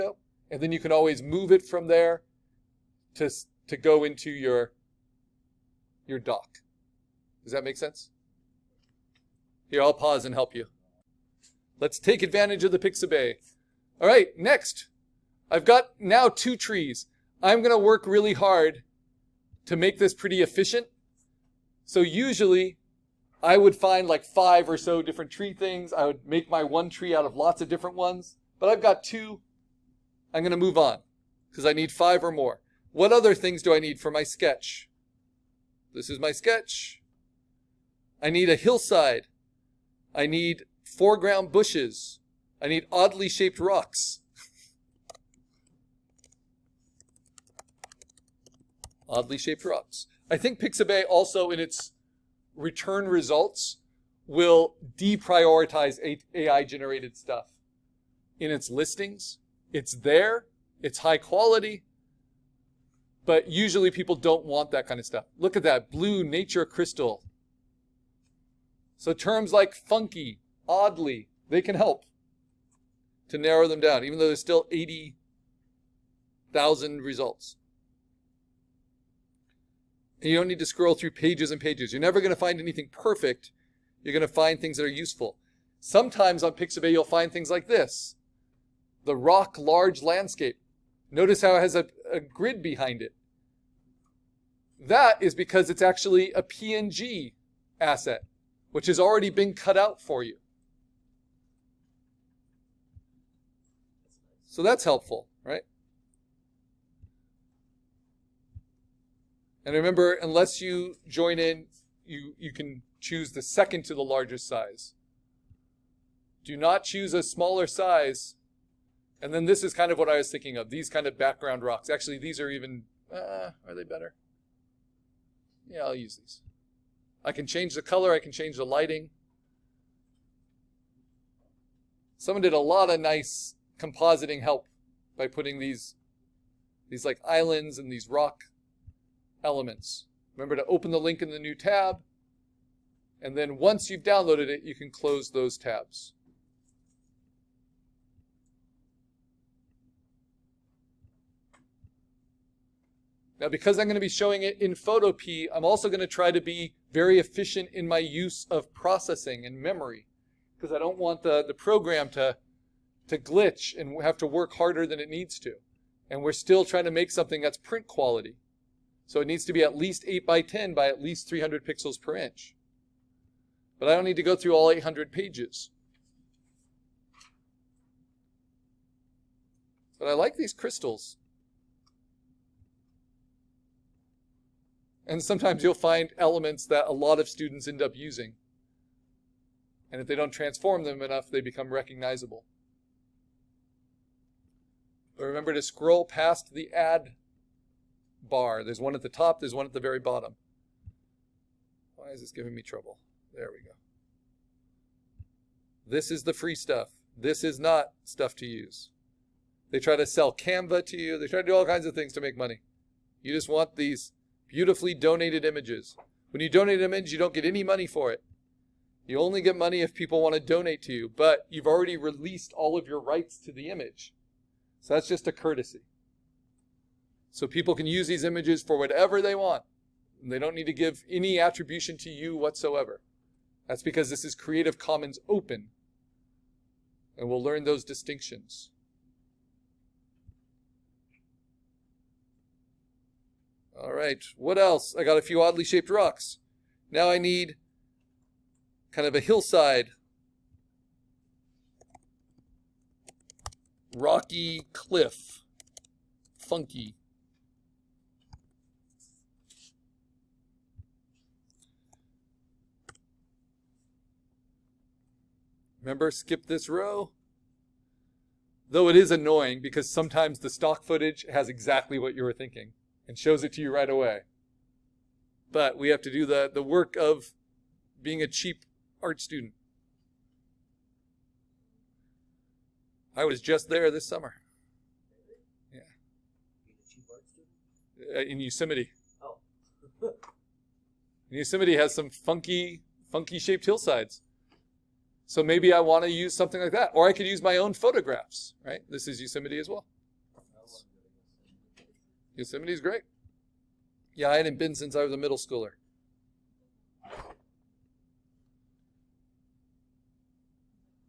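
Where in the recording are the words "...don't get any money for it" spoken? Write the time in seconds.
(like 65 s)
217 s.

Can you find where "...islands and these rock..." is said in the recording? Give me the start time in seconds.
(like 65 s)
137 s.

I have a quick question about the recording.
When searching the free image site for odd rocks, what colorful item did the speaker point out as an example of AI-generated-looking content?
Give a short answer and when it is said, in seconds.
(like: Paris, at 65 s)
blue nature crystal, at 65 s.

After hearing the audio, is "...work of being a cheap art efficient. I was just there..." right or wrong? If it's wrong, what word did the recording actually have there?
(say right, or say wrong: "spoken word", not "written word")
wrong: "student", not "efficient".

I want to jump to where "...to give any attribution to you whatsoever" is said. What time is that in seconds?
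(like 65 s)
230 s.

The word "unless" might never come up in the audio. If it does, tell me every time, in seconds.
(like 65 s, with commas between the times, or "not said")
110 s.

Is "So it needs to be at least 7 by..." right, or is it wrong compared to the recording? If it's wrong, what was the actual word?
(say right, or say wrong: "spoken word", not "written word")
wrong: "8", not "7".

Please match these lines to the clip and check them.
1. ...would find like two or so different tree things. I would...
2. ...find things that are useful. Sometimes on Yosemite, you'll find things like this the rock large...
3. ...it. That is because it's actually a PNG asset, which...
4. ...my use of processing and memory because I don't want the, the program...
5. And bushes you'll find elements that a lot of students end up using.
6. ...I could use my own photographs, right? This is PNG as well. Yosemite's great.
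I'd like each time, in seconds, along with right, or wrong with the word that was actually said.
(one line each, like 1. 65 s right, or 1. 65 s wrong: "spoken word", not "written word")
1. 23 s wrong: "five", not "two"
2. 84 s wrong: "Pixabay", not "Yosemite"
3. 93 s right
4. 157 s right
5. 185 s wrong: "sometimes", not "bushes"
6. 297 s wrong: "Yosemite", not "PNG".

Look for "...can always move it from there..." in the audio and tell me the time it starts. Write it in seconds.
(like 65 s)
0 s.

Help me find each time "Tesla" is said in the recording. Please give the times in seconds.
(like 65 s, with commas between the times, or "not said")
not said.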